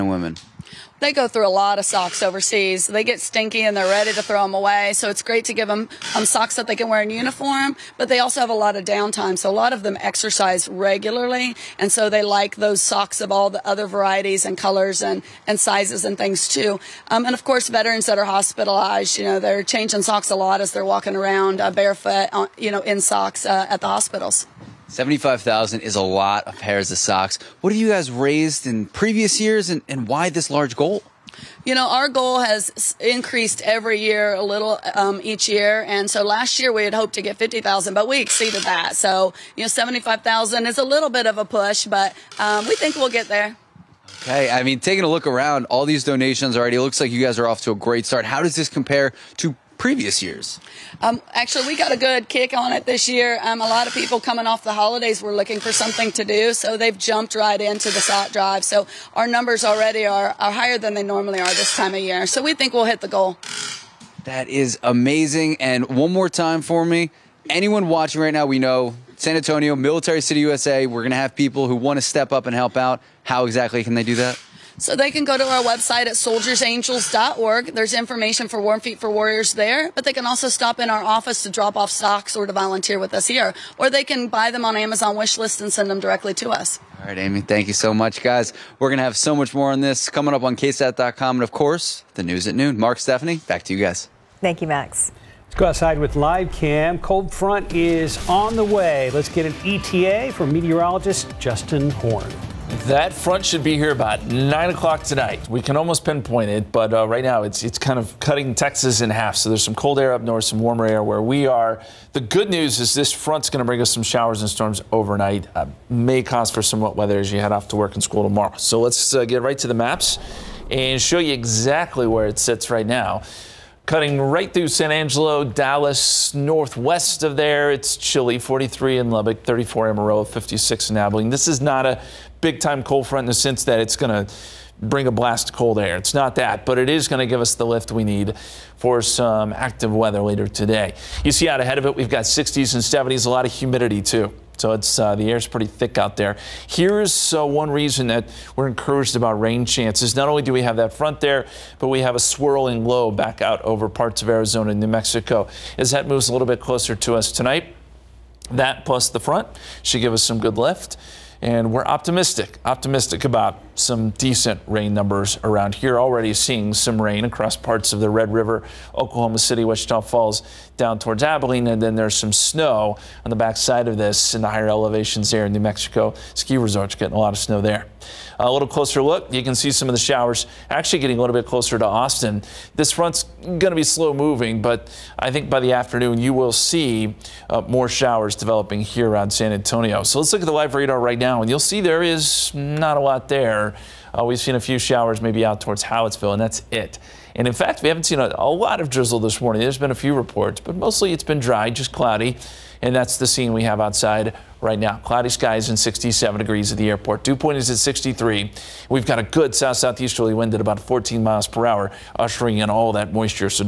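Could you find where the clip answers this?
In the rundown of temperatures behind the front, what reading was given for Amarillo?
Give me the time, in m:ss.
2:09.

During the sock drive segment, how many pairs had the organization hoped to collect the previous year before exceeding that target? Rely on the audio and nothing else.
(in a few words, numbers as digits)
50,000.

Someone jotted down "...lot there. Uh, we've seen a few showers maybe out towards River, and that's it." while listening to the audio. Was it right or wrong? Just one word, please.
wrong.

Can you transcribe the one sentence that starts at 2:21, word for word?
You see out ahead of it, we've got 60s and 70s, a lot of humidity too.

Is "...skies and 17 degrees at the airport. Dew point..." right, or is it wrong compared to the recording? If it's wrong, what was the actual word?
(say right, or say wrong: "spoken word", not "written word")
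wrong: "67", not "17".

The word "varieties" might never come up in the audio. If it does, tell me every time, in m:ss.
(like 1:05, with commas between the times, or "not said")
0:13.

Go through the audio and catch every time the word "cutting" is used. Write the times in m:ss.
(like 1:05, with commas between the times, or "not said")
1:48, 2:03.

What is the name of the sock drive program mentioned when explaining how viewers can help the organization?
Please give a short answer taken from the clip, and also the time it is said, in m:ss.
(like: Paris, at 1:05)
Warm Feet for Warriors, at 1:18.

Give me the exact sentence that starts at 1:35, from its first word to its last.
Let's go outside with live cam.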